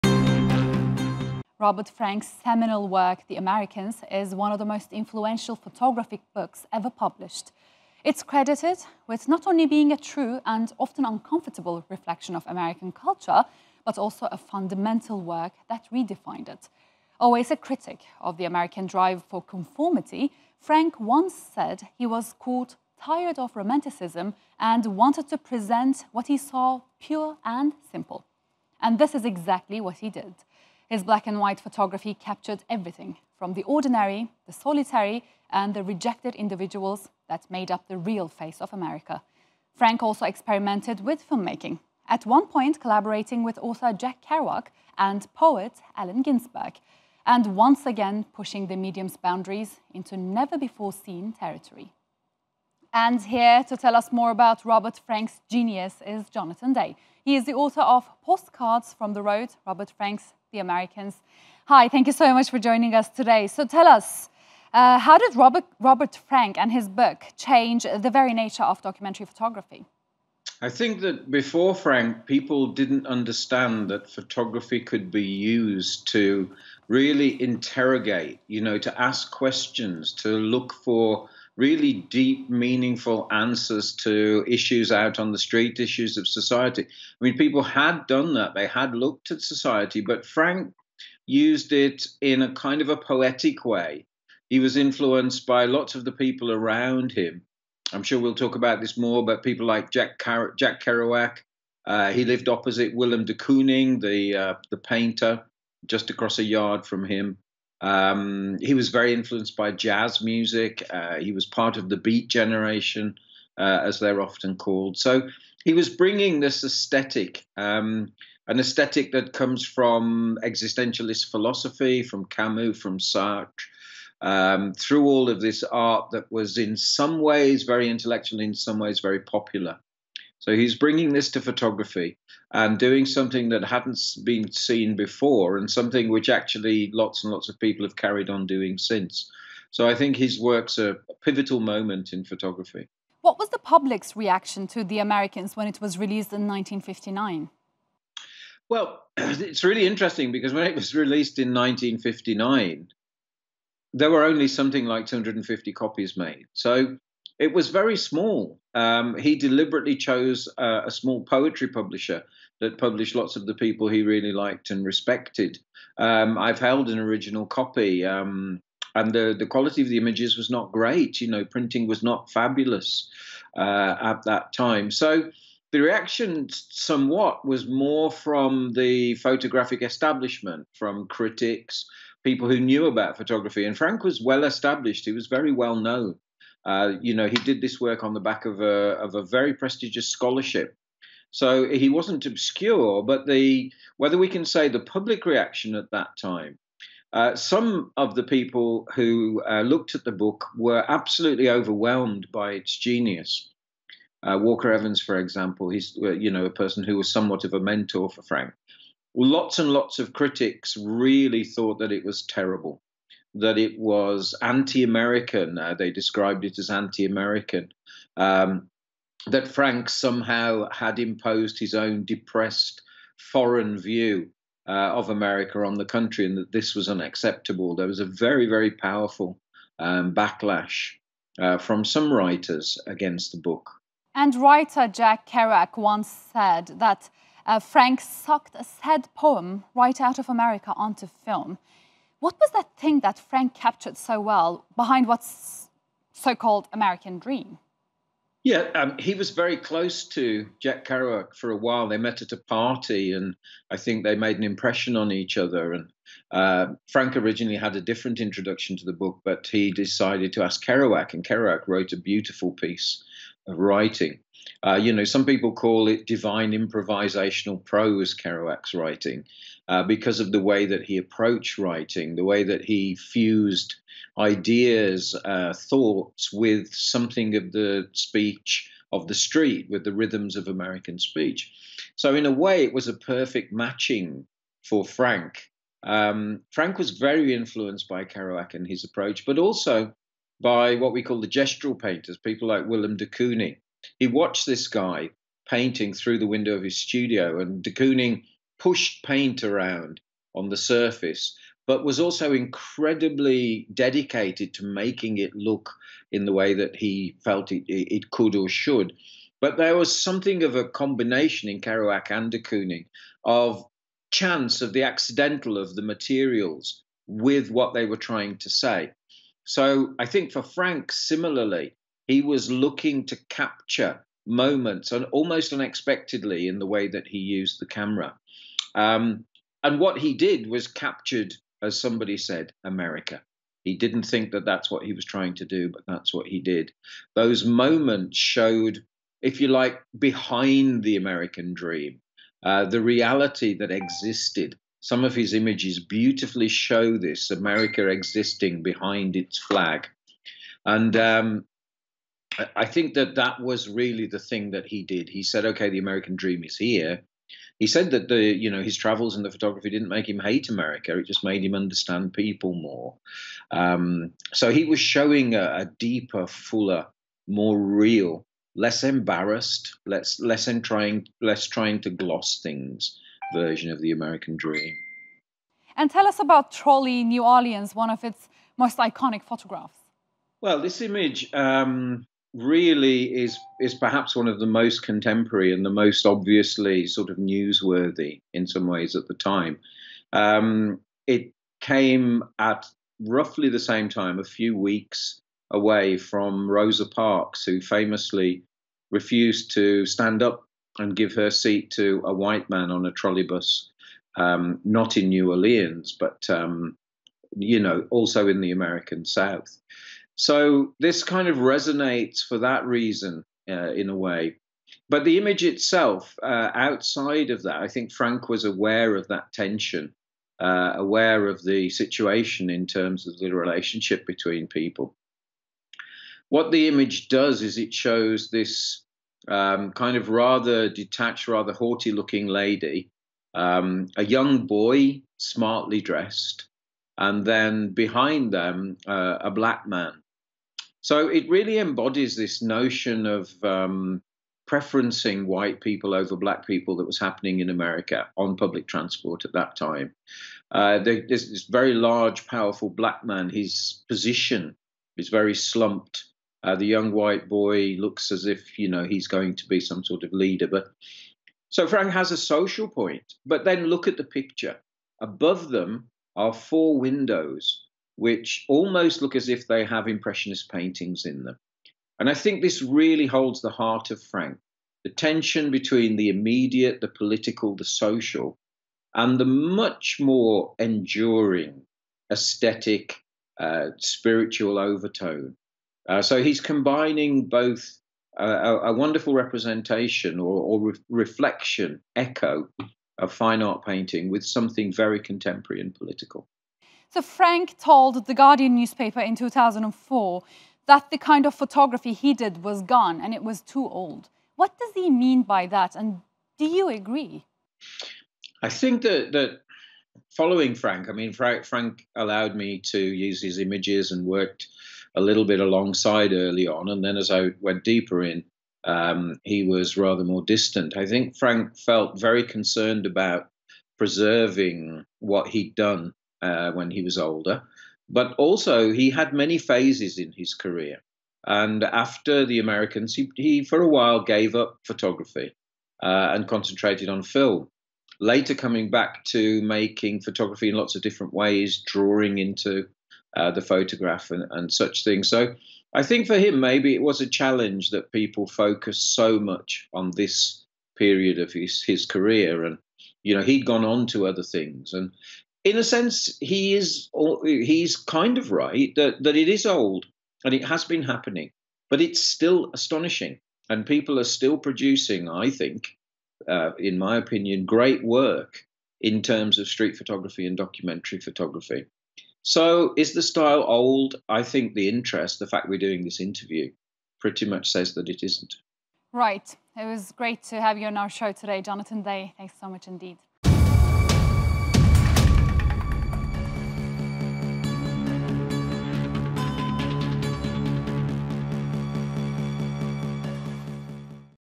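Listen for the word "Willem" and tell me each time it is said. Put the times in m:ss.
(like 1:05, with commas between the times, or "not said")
1:42, 4:52.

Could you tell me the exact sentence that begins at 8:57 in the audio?
Later, coming back to making photography in lots of different ways, drawing into uh, the photograph and, and such things.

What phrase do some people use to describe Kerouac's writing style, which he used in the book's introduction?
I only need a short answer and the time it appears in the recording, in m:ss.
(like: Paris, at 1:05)
divine improvisational prose, at 4:26.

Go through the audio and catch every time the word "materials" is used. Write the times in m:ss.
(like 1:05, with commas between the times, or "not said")
5:15.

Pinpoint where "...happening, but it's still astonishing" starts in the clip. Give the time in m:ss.
9:20.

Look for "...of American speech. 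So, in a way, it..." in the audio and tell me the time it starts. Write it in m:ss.
4:40.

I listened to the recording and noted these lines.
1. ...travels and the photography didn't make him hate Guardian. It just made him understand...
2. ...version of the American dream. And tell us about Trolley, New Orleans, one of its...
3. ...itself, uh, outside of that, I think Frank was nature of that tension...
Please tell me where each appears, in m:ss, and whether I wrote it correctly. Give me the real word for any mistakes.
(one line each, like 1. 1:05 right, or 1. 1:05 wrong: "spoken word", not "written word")
1. 5:58 wrong: "America", not "Guardian"
2. 6:13 right
3. 6:55 wrong: "aware", not "nature".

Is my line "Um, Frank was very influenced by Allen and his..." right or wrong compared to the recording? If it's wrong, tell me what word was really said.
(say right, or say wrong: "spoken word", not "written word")
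wrong: "Kerouac", not "Allen".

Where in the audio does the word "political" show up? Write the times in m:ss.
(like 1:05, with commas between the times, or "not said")
7:56, 8:15.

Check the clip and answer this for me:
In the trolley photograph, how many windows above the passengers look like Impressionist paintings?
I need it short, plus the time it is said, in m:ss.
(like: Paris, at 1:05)
4, at 7:46.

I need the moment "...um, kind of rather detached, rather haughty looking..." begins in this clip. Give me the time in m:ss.
7:09.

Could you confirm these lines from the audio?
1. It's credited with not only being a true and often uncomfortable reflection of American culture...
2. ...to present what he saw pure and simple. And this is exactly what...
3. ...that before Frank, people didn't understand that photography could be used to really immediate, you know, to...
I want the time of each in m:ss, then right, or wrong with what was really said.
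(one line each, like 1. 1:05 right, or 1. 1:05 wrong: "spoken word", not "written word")
1. 0:08 right
2. 0:25 right
3. 1:11 wrong: "interrogate", not "immediate".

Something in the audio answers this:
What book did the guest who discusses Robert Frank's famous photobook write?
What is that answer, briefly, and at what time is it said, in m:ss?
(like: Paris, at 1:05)
Postcards from the Road, at 0:58.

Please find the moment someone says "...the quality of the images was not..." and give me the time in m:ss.
2:49.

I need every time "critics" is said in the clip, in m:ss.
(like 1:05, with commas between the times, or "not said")
0:17, 3:01, 3:30.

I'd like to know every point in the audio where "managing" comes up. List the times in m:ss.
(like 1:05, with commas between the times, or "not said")
not said.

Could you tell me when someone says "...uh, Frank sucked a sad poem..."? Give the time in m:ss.
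3:57.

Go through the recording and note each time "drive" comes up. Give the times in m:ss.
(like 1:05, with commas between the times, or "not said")
0:18.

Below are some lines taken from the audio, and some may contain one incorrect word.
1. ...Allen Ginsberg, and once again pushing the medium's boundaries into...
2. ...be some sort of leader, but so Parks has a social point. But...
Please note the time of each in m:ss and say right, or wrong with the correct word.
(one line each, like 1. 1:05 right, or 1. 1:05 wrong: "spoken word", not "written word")
1. 0:45 right
2. 7:39 wrong: "Frank", not "Parks".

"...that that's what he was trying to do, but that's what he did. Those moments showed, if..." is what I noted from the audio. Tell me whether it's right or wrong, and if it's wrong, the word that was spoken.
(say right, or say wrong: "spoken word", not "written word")
right.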